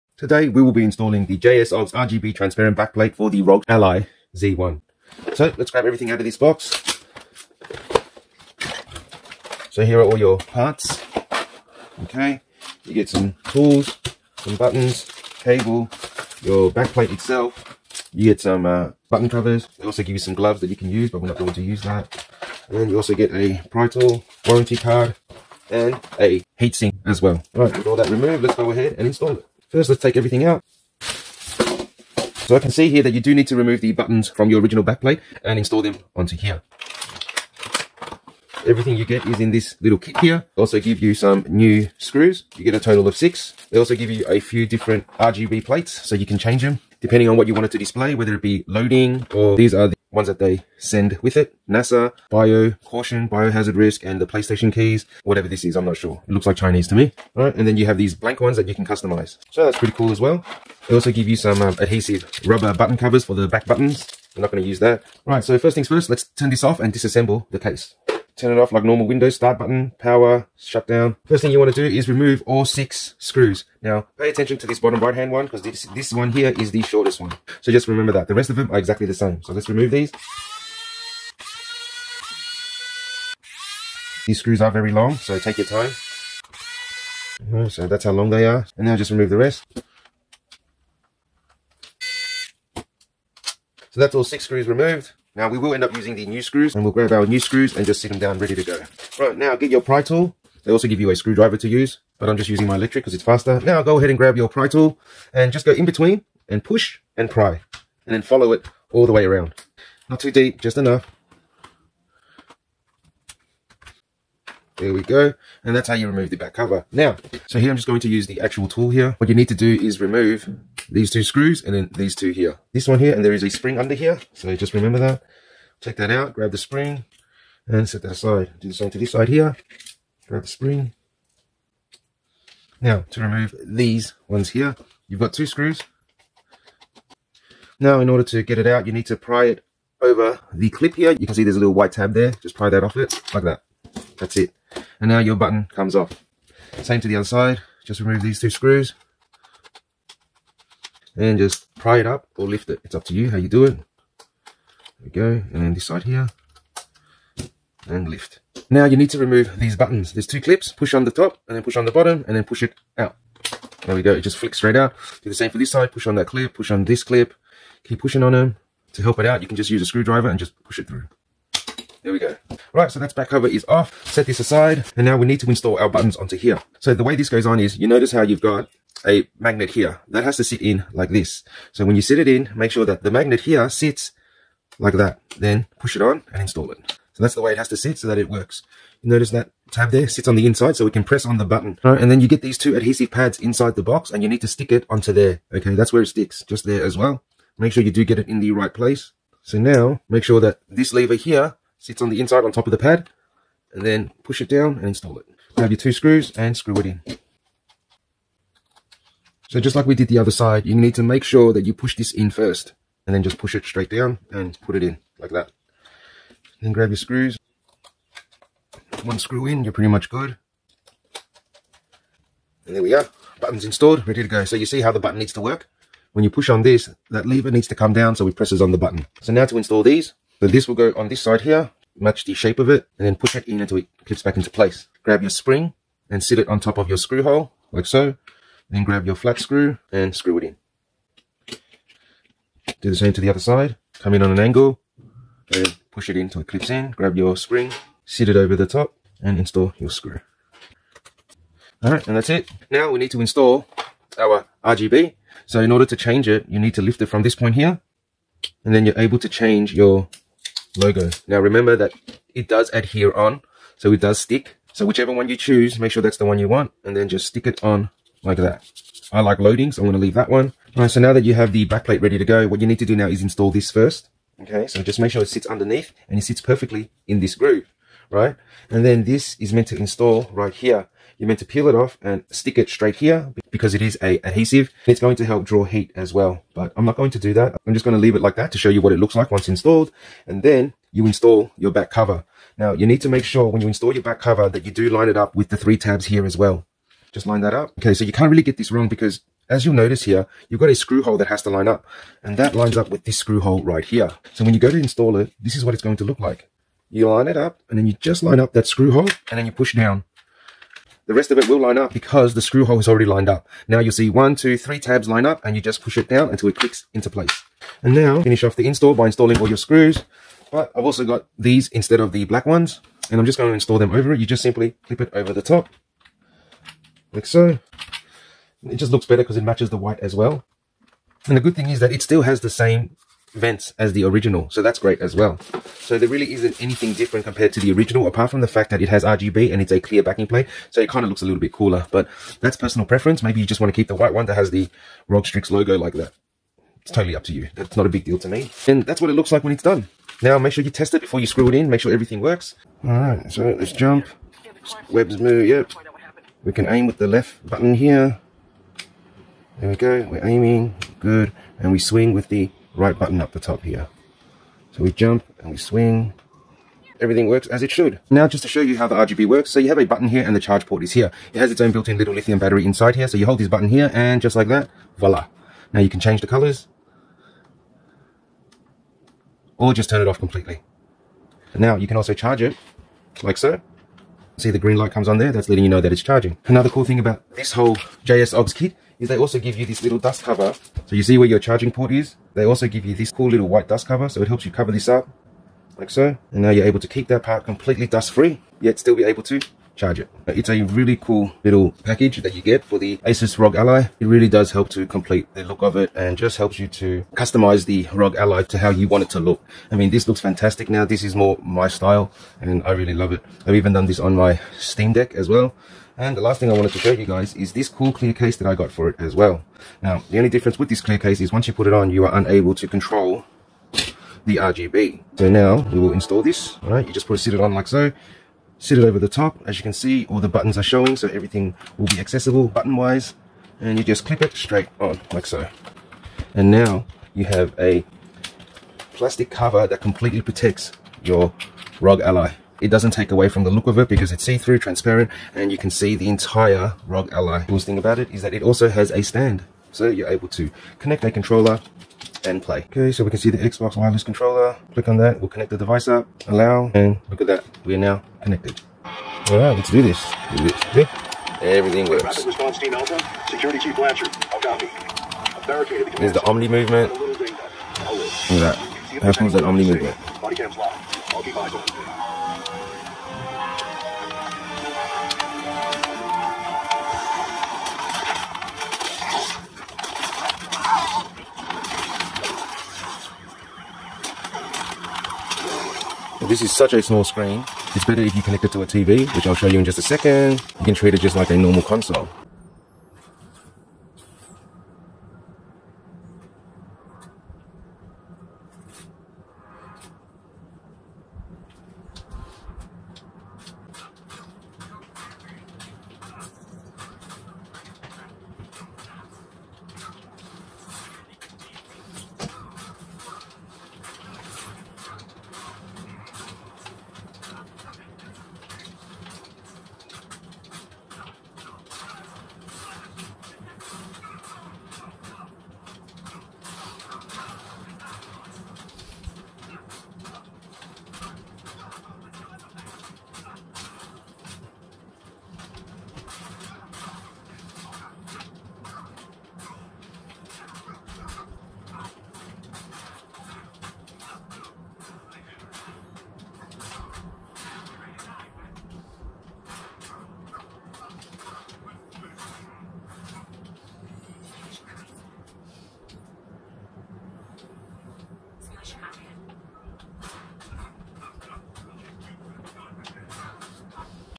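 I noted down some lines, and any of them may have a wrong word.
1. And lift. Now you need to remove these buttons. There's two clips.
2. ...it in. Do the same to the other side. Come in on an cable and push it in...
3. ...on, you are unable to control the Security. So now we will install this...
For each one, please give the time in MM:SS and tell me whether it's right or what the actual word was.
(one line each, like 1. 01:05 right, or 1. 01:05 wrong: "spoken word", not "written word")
1. 02:37 right
2. 04:00 wrong: "angle", not "cable"
3. 07:01 wrong: "RGB", not "Security".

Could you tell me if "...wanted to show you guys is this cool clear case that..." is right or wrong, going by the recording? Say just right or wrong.
right.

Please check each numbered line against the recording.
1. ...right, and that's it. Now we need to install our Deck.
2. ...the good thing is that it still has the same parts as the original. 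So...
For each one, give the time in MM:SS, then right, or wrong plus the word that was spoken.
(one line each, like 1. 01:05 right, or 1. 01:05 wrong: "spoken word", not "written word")
1. 04:11 wrong: "RGB", not "Deck"
2. 05:31 wrong: "vents", not "parts".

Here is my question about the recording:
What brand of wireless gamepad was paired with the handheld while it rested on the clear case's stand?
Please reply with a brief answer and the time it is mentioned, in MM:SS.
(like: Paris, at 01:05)
Xbox, at 07:33.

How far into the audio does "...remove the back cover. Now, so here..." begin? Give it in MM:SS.
01:56.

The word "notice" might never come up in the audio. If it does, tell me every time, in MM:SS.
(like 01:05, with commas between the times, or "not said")
02:57, 03:09, 04:59.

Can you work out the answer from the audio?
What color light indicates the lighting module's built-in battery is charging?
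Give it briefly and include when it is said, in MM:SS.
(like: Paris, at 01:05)
green, at 06:24.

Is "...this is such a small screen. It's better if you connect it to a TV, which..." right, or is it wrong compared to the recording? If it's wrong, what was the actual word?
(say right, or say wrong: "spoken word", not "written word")
right.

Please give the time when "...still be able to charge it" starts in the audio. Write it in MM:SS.
06:38.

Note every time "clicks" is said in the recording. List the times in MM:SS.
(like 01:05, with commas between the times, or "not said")
05:16, 07:34.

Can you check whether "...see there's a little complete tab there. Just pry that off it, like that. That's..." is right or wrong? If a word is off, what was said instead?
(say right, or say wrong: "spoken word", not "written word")
wrong: "white", not "complete".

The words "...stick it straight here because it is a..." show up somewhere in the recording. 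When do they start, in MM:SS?
04:42.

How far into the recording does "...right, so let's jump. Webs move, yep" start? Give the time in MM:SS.
05:52.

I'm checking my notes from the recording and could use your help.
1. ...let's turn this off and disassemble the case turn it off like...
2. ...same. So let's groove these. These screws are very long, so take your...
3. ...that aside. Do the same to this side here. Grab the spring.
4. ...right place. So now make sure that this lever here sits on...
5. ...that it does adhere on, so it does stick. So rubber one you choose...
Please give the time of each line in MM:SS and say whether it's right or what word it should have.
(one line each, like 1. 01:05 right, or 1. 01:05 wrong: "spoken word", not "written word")
1. 01:06 right
2. 01:19 wrong: "remove", not "groove"
3. 02:08 right
4. 03:18 right
5. 04:21 wrong: "whichever", not "rubber".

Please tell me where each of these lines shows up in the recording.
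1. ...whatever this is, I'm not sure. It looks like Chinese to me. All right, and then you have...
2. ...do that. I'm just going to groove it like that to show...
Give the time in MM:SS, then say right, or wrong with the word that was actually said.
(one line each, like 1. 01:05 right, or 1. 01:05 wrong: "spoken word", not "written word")
1. 00:55 right
2. 04:47 wrong: "leave", not "groove".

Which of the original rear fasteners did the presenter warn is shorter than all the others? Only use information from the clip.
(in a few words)
bottom right hand one.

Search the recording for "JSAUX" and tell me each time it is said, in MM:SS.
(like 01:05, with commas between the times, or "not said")
00:01, 06:28.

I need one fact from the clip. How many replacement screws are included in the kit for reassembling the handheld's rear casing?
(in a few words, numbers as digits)
6.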